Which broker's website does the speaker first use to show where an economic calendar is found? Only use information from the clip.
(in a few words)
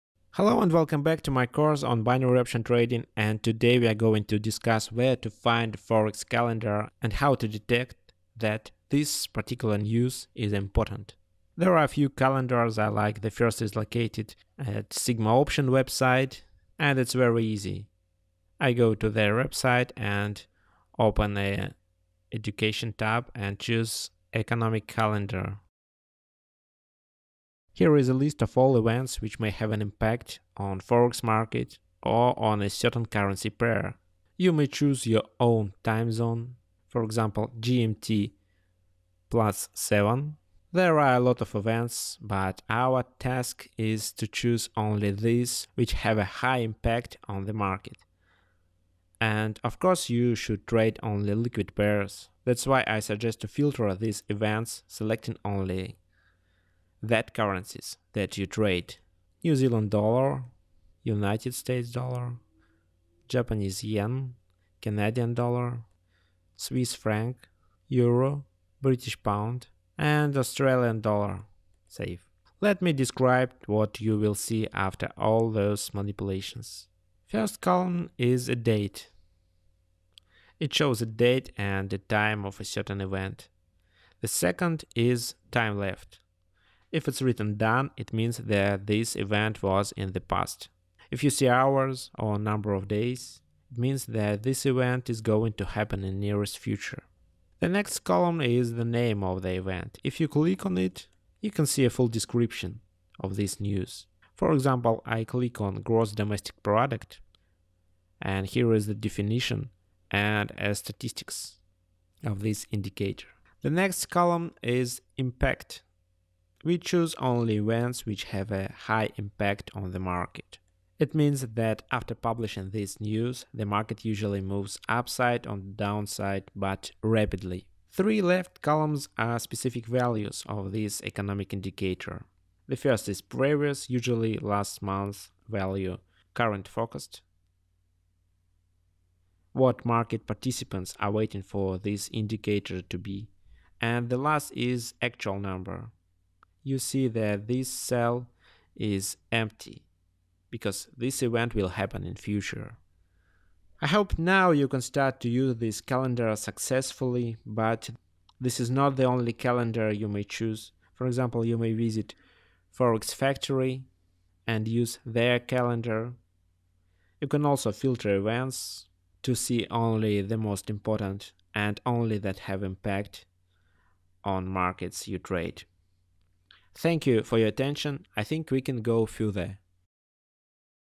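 Sigma Option.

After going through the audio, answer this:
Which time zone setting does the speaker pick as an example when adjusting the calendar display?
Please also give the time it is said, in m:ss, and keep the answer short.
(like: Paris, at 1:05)
GMT+7, at 0:37.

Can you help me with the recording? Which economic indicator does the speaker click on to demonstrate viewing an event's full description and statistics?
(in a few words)
Gross domestic product.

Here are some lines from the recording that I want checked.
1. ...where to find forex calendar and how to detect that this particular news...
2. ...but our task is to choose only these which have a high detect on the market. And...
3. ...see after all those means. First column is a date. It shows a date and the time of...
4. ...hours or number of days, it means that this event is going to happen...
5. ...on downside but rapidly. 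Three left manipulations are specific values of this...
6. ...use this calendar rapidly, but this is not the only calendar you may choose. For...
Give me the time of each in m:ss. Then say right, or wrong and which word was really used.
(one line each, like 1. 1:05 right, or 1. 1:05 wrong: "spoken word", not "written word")
1. 0:04 right
2. 0:42 wrong: "impact", not "detect"
3. 1:14 wrong: "manipulations", not "means"
4. 1:31 right
5. 2:05 wrong: "columns", not "manipulations"
6. 2:35 wrong: "successfully", not "rapidly".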